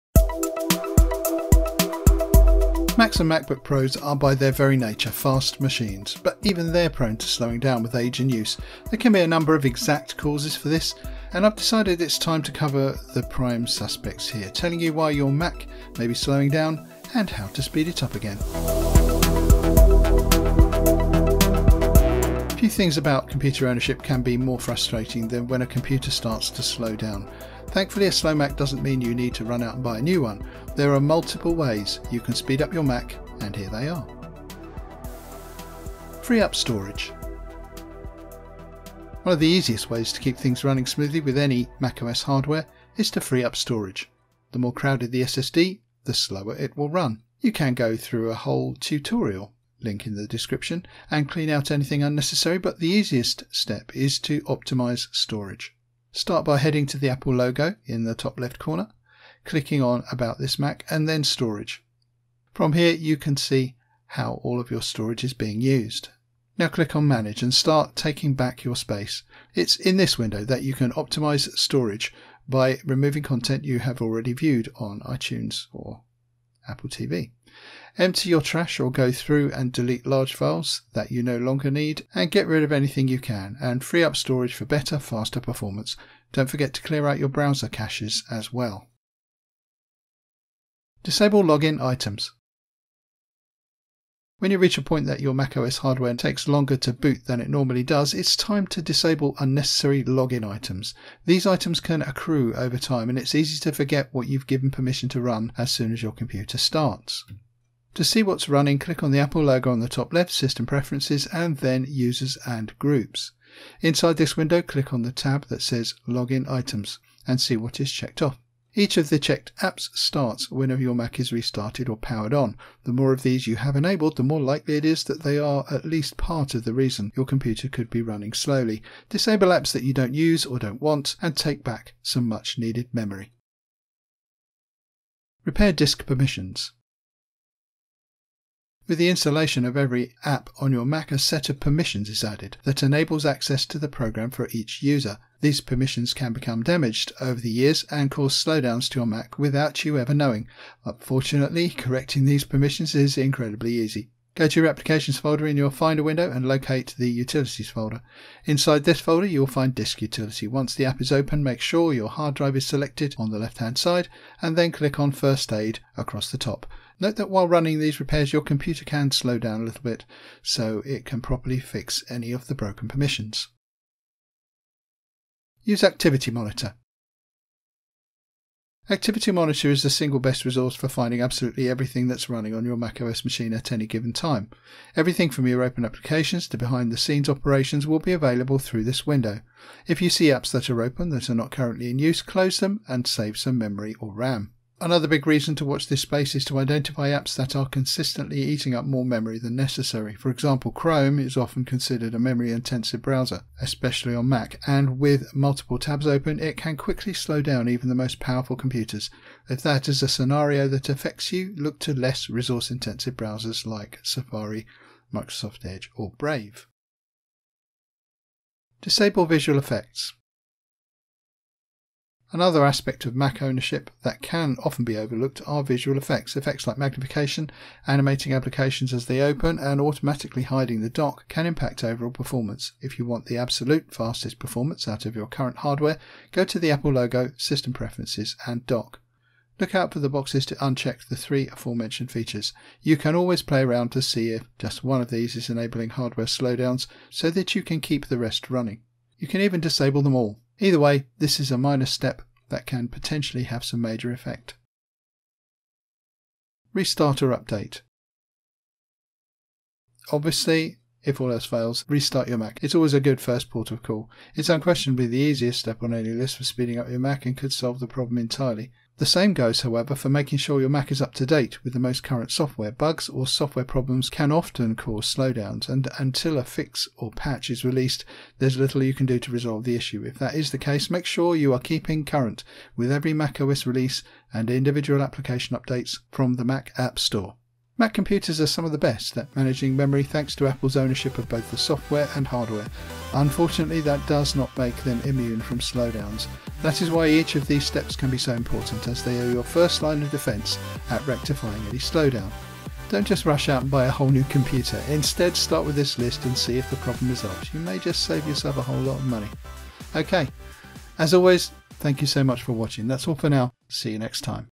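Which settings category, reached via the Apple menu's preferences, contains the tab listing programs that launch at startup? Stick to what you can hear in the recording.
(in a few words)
Users and Groups.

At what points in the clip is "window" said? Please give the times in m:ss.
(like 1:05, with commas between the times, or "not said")
1:10, 1:54, 2:36, 3:09.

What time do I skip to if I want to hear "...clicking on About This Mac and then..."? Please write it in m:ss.
0:59.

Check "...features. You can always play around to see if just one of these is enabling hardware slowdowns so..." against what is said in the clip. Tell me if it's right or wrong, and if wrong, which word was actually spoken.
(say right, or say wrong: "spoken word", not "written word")
right.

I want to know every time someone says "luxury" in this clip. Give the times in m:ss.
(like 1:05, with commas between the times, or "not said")
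not said.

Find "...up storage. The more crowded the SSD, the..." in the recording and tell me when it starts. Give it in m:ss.
0:43.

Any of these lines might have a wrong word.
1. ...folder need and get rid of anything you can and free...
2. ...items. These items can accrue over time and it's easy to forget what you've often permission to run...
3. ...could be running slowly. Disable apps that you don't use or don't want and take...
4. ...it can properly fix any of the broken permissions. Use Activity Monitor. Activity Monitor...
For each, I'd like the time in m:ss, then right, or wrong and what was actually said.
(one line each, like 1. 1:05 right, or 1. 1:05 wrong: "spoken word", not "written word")
1. 1:21 wrong: "longer", not "folder"
2. 1:40 wrong: "given", not "often"
3. 2:07 right
4. 2:50 right.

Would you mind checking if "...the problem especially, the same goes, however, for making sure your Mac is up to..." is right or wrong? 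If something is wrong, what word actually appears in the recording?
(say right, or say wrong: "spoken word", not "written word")
wrong: "entirely", not "especially".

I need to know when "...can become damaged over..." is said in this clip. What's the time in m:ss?
2:26.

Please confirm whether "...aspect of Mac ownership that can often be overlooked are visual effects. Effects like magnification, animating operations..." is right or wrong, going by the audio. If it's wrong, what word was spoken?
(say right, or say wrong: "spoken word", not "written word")
wrong: "applications", not "operations".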